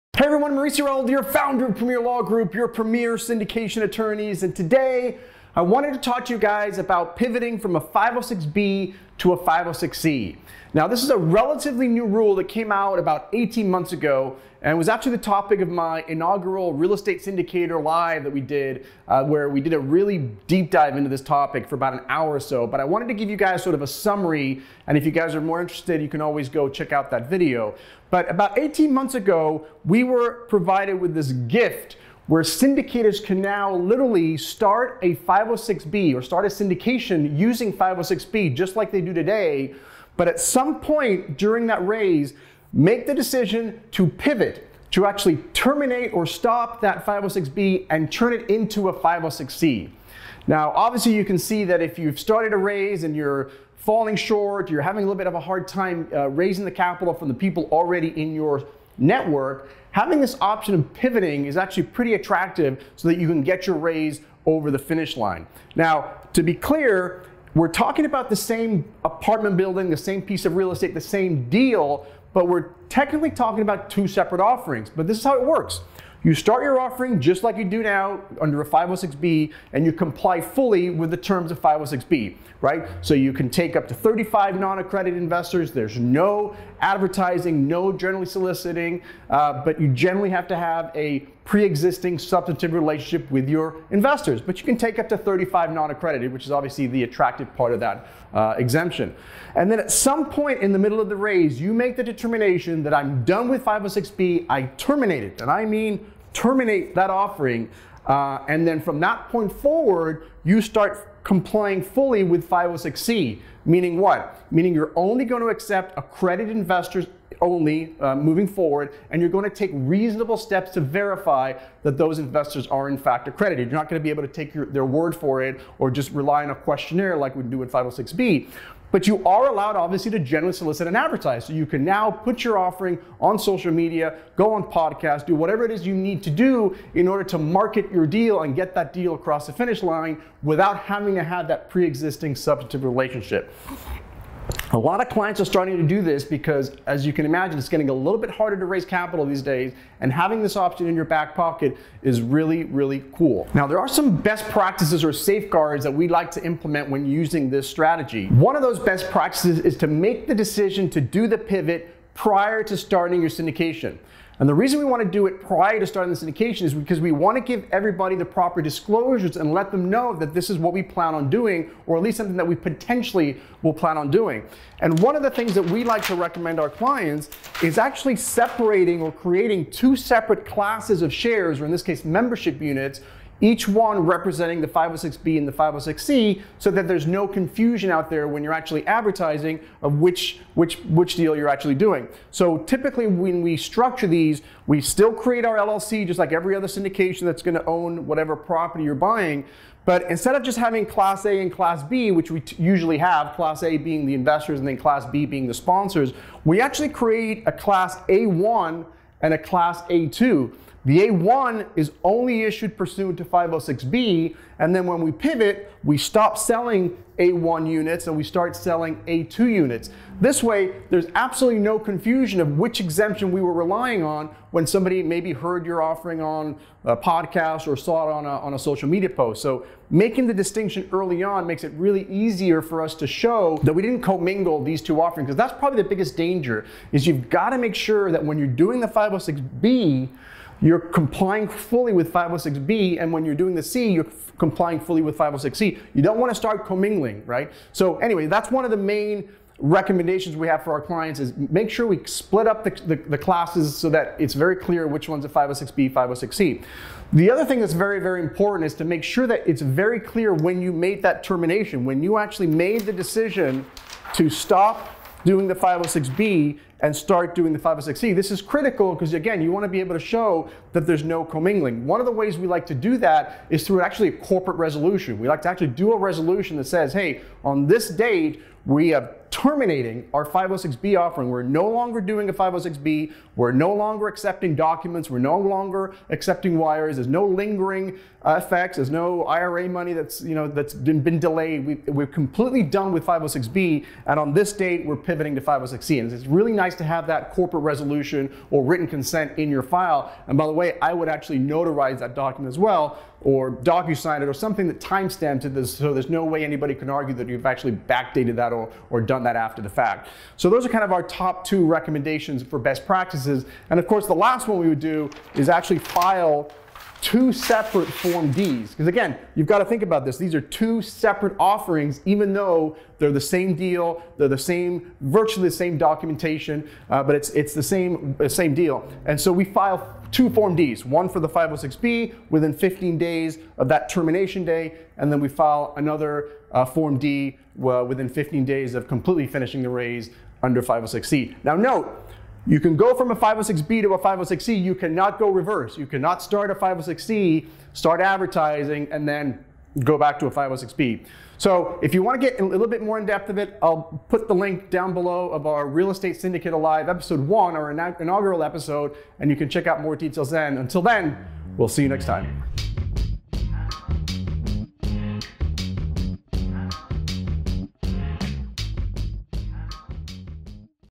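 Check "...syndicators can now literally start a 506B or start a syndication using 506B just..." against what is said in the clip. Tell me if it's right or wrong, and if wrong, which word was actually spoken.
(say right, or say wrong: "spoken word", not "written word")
right.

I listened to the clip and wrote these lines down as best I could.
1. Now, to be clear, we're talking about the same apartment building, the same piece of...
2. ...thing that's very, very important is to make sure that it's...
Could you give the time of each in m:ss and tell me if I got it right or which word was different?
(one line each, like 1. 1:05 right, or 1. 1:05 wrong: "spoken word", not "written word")
1. 1:05 right
2. 4:17 right.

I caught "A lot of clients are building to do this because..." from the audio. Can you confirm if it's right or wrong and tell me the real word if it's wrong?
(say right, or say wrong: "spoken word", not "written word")
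wrong: "starting", not "building".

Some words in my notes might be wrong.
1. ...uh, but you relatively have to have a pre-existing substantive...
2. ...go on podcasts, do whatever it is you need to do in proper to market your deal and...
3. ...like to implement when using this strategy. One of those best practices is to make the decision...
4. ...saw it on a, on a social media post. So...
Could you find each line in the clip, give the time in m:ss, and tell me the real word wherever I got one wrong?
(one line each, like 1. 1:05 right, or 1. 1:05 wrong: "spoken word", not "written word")
1. 1:29 wrong: "generally", not "relatively"
2. 2:14 wrong: "order", not "proper"
3. 2:36 right
4. 3:47 right.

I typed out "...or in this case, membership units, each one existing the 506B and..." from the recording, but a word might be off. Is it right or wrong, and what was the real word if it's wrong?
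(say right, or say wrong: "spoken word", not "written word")
wrong: "representing", not "existing".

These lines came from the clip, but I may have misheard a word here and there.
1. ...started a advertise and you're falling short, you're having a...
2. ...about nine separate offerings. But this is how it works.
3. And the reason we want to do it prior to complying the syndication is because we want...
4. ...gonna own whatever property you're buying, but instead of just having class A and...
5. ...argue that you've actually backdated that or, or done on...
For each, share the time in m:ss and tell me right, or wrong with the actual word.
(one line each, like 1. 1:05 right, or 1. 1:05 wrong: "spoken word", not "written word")
1. 0:52 wrong: "raise", not "advertise"
2. 1:13 wrong: "two", not "nine"
3. 2:44 wrong: "starting", not "complying"
4. 3:17 right
5. 5:06 right.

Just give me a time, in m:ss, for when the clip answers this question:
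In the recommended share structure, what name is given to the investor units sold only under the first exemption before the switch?
3:27.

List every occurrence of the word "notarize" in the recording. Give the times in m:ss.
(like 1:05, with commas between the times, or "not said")
5:01.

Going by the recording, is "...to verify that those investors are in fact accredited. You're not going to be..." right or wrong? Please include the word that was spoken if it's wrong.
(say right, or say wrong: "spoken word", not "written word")
right.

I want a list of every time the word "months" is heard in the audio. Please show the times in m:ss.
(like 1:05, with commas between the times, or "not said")
0:13, 0:28.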